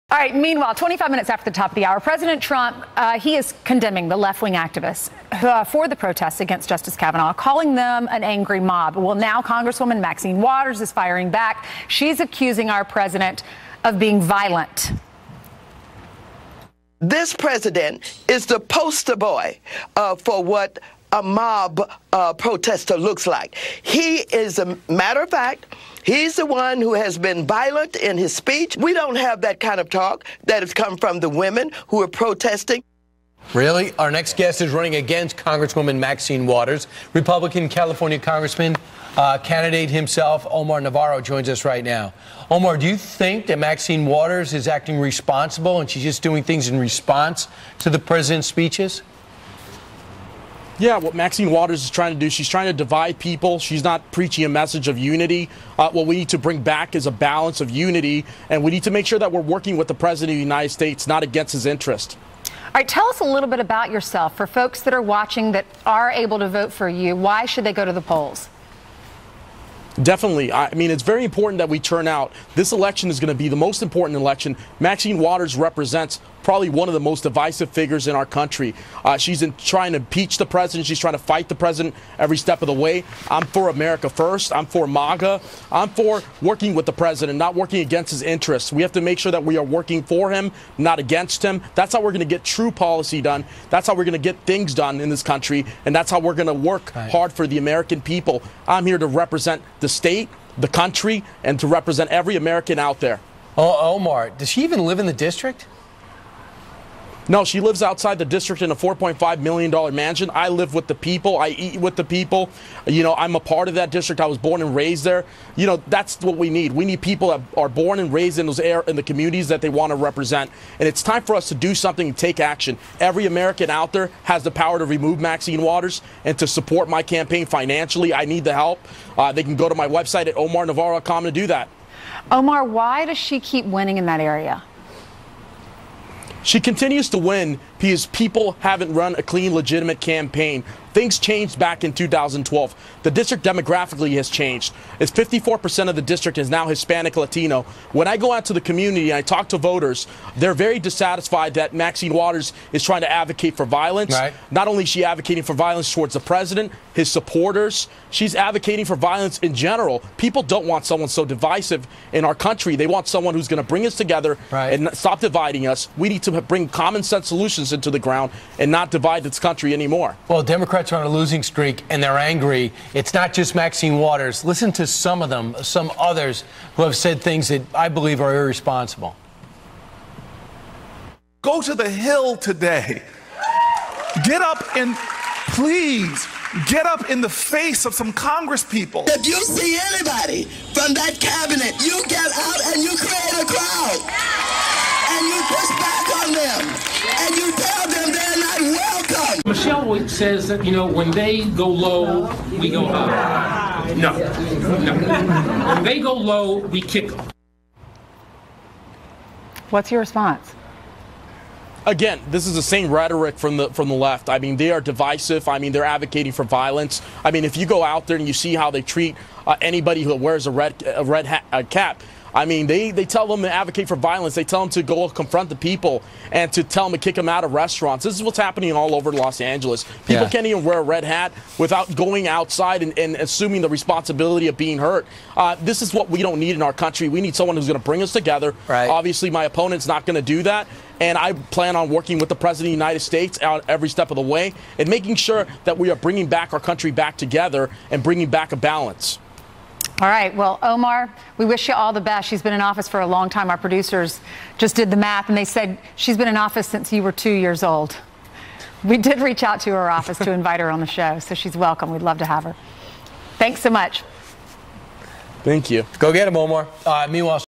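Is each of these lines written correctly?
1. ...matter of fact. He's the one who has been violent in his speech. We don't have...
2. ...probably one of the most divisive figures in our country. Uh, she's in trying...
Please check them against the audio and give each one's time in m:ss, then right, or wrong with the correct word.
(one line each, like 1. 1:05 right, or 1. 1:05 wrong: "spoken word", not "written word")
1. 0:24 right
2. 1:16 right.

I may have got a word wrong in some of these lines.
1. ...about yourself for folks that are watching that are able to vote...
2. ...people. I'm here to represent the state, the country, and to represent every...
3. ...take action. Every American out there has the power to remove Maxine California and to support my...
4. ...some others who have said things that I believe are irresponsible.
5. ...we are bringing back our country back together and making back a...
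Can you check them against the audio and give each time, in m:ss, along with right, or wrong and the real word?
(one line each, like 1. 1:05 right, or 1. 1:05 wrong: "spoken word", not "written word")
1. 1:03 right
2. 1:38 right
3. 2:02 wrong: "Waters", not "California"
4. 2:55 right
5. 4:05 wrong: "bringing", not "making".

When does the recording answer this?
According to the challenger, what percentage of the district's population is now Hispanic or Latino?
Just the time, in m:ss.
2:25.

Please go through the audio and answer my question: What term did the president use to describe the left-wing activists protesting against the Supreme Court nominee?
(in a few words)
angry mob.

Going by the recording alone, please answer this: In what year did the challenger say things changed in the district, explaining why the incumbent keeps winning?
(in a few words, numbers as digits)
2012.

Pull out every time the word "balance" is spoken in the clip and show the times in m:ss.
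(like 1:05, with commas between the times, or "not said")
0:57, 4:08.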